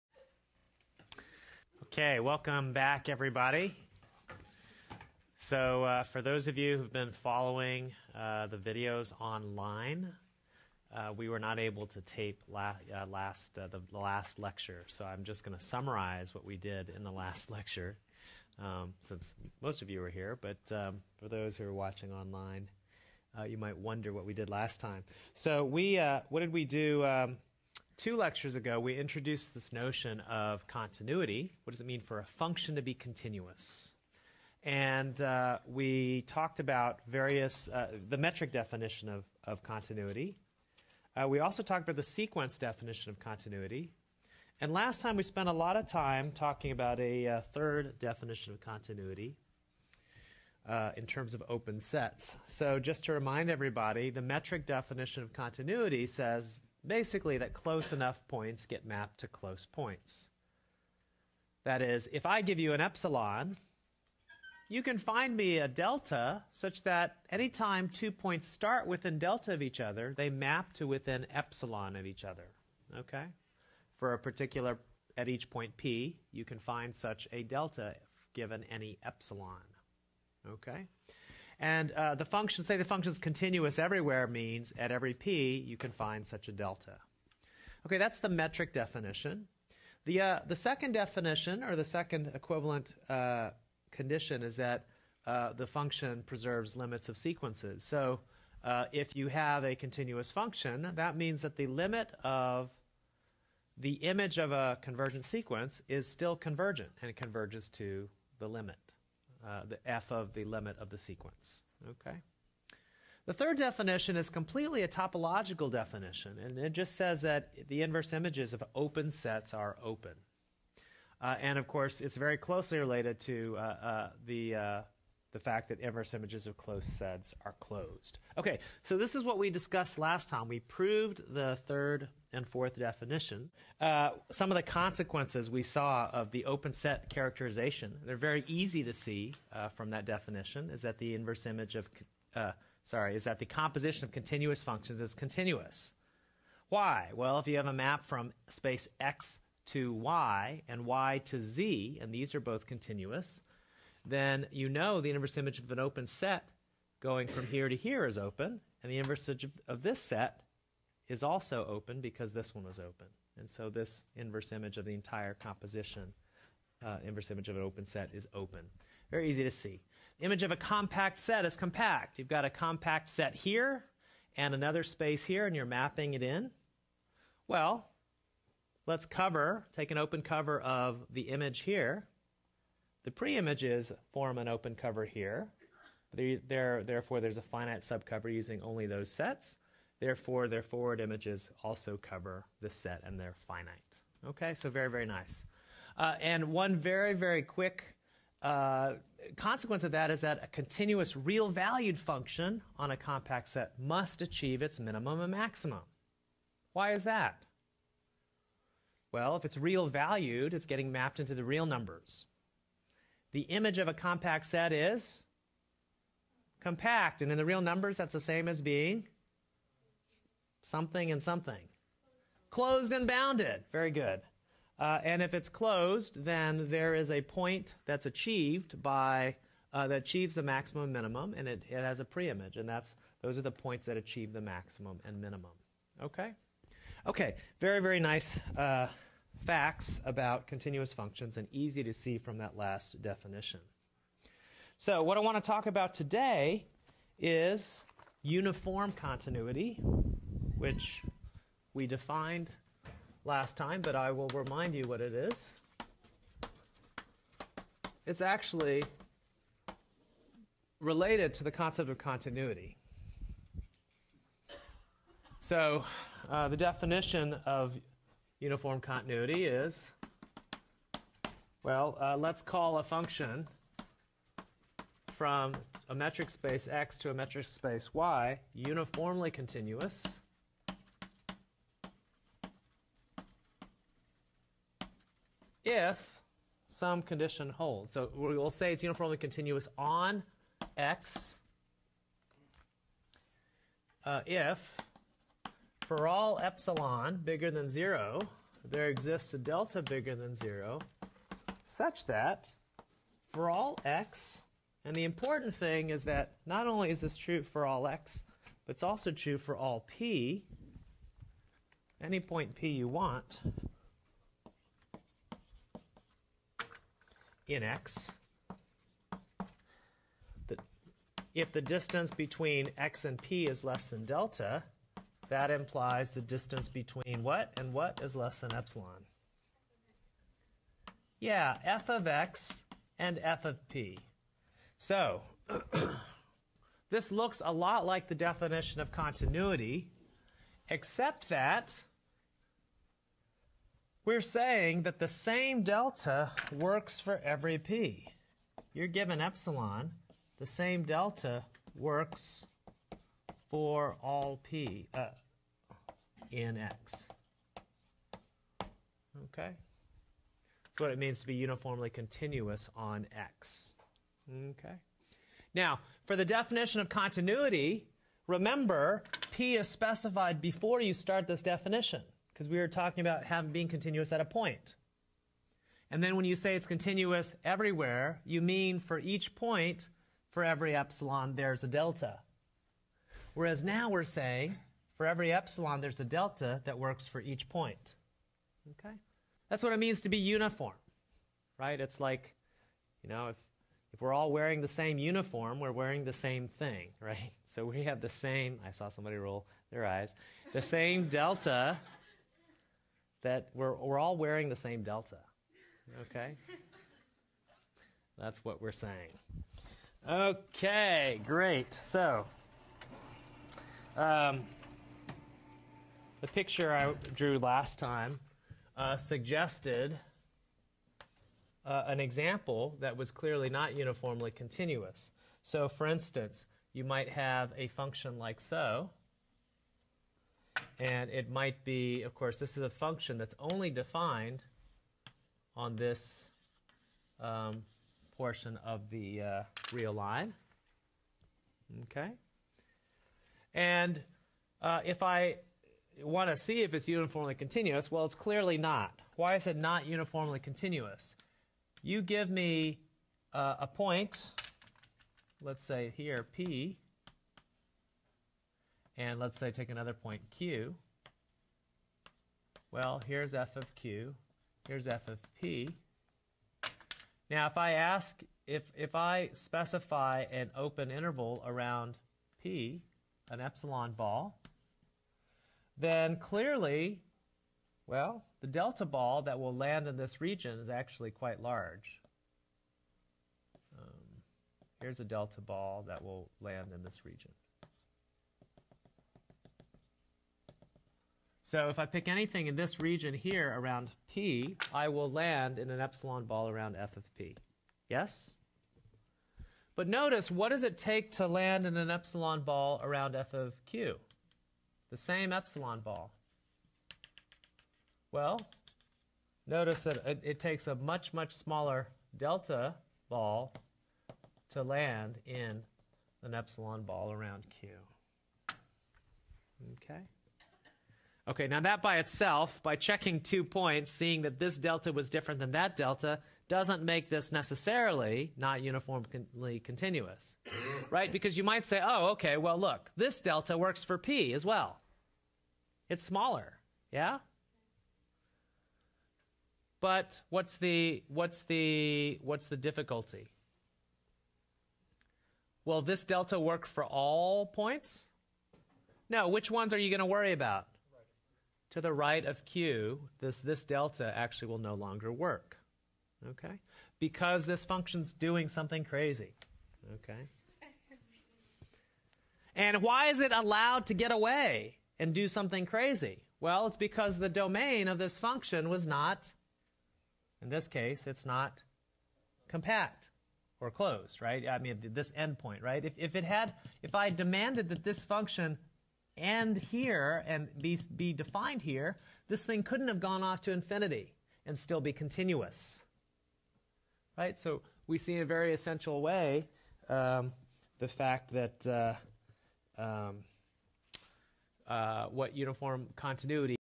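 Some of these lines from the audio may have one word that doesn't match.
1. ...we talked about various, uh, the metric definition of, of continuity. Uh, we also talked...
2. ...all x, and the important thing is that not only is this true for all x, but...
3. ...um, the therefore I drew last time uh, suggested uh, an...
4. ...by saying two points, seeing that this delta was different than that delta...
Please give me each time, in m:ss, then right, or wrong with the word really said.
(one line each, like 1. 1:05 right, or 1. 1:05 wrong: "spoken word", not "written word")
1. 0:35 right
2. 5:03 right
3. 6:53 wrong: "picture", not "therefore"
4. 8:42 wrong: "checking", not "saying".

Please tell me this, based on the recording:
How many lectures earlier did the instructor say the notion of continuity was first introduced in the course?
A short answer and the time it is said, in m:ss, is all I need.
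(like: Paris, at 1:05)
2, at 0:28.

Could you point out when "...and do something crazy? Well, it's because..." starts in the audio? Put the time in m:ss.
9:24.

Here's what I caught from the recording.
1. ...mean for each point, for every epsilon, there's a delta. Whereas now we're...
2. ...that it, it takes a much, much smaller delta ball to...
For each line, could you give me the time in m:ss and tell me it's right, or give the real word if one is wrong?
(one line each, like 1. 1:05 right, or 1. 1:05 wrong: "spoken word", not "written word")
1. 6:18 right
2. 8:29 right.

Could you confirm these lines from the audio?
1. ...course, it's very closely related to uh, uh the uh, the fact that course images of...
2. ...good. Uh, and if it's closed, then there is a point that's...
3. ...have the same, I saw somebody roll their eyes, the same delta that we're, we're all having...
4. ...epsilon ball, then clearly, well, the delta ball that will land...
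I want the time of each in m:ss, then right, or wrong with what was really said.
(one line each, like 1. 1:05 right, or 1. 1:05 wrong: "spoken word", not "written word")
1. 2:01 wrong: "inverse", not "course"
2. 3:43 right
3. 6:37 wrong: "wearing", not "having"
4. 7:53 right.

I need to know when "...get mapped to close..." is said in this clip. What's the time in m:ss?
0:58.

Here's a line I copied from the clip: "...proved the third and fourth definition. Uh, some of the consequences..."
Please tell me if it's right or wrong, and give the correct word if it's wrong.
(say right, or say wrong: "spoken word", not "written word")
right.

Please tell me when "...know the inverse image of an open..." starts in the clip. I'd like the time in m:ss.
2:34.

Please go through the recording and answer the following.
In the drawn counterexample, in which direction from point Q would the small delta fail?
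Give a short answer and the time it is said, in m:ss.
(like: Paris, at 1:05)
To the right, at 9:11.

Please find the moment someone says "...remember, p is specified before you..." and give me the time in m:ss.
6:08.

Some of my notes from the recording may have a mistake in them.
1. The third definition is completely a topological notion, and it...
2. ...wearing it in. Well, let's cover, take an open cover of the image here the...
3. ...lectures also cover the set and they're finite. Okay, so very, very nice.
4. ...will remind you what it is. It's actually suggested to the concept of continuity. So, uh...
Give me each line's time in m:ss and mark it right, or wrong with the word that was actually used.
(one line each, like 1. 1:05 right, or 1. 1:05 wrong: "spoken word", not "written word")
1. 1:53 wrong: "definition", not "notion"
2. 2:55 wrong: "mapping", not "wearing"
3. 3:11 wrong: "images", not "lectures"
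4. 4:14 wrong: "related", not "suggested".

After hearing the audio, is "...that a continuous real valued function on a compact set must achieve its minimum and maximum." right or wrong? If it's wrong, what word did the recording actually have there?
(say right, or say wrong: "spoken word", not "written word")
right.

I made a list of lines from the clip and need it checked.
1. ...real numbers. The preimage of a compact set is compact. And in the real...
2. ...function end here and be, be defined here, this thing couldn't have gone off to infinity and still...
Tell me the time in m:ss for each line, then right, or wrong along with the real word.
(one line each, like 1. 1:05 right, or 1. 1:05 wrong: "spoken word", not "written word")
1. 3:31 wrong: "image", not "preimage"
2. 9:38 right.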